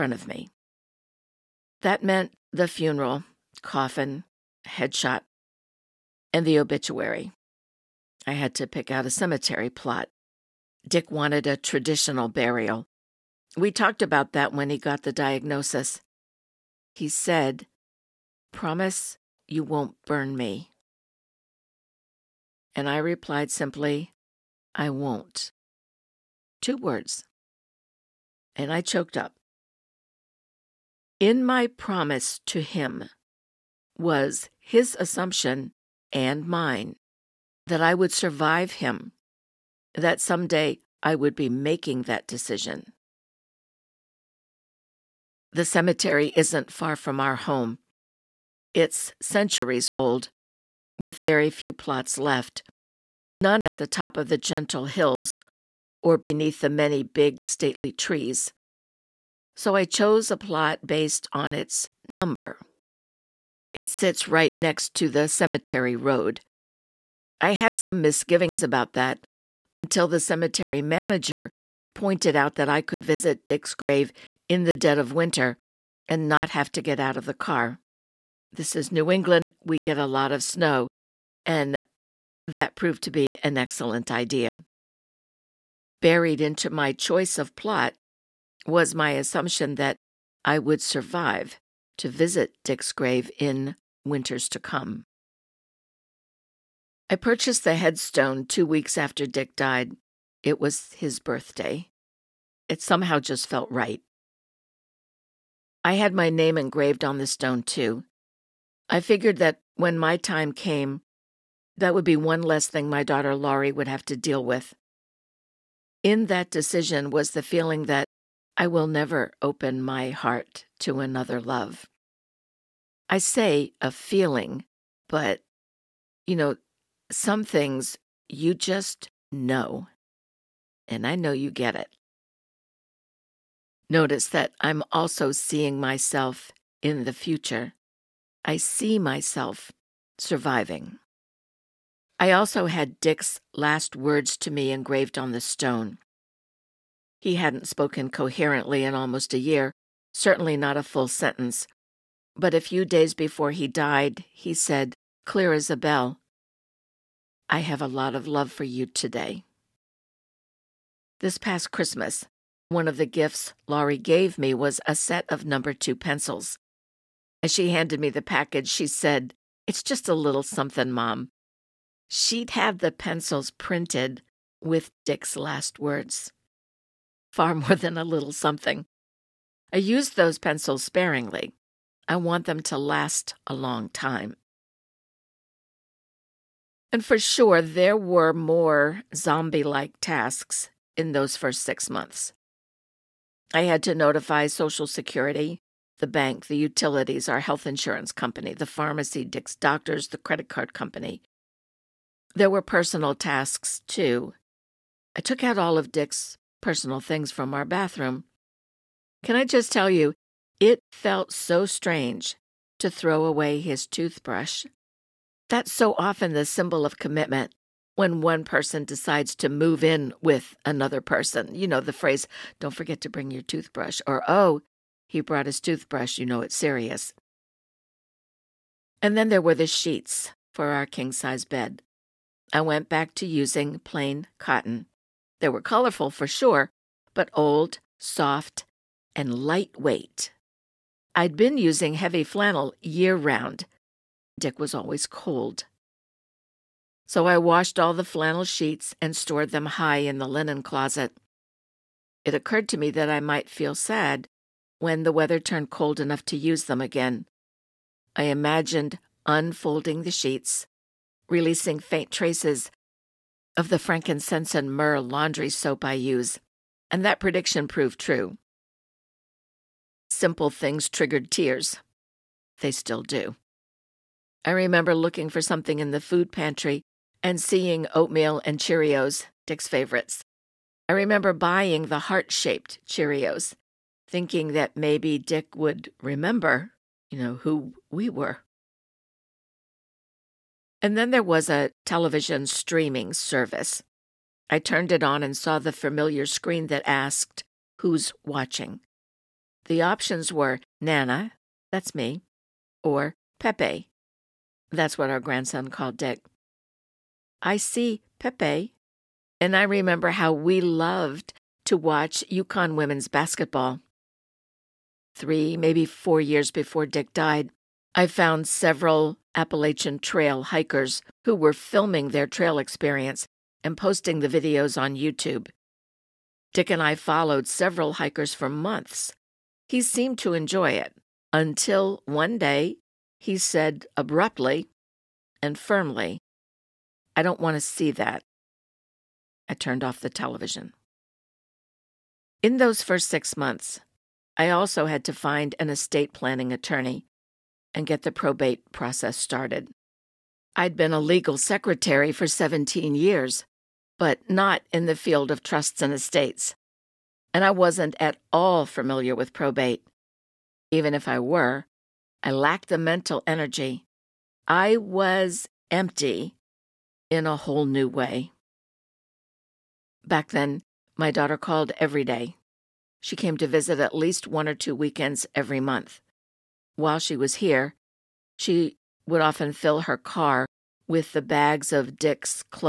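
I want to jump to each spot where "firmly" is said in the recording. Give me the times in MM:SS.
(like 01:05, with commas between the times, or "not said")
05:35.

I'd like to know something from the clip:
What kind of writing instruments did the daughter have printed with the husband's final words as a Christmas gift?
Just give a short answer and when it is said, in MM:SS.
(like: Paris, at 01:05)
Number two pencils, at 02:45.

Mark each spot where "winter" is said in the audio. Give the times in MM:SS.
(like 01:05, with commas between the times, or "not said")
01:15, 01:34.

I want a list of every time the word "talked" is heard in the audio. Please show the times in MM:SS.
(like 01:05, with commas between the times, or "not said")
00:13.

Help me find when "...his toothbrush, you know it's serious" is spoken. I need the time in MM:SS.
03:45.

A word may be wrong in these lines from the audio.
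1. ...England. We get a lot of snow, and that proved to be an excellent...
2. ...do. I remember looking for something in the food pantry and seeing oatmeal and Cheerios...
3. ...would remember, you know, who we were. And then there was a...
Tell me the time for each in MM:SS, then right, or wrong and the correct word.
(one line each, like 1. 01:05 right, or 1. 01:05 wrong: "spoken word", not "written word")
1. 01:19 right
2. 04:33 right
3. 04:45 right.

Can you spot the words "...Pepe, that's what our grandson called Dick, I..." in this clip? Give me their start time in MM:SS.
05:03.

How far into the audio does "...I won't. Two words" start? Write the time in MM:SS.
00:24.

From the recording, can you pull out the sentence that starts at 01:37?
I purchased the headstone two weeks after Dick died it was his birthday.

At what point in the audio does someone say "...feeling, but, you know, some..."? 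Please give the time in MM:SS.
02:03.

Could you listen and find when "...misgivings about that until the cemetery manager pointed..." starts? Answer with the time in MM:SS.
01:08.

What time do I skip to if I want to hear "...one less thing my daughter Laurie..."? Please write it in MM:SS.
01:52.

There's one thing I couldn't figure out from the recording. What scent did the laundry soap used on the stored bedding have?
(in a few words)
Frankincense and myrrh.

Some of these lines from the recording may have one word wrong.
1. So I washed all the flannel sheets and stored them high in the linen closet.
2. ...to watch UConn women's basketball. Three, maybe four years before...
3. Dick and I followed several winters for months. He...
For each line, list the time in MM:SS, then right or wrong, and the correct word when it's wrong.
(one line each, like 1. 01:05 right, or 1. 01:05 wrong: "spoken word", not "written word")
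1. 04:07 right
2. 05:11 right
3. 05:26 wrong: "hikers", not "winters".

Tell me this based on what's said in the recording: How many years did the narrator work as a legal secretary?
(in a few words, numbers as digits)
17.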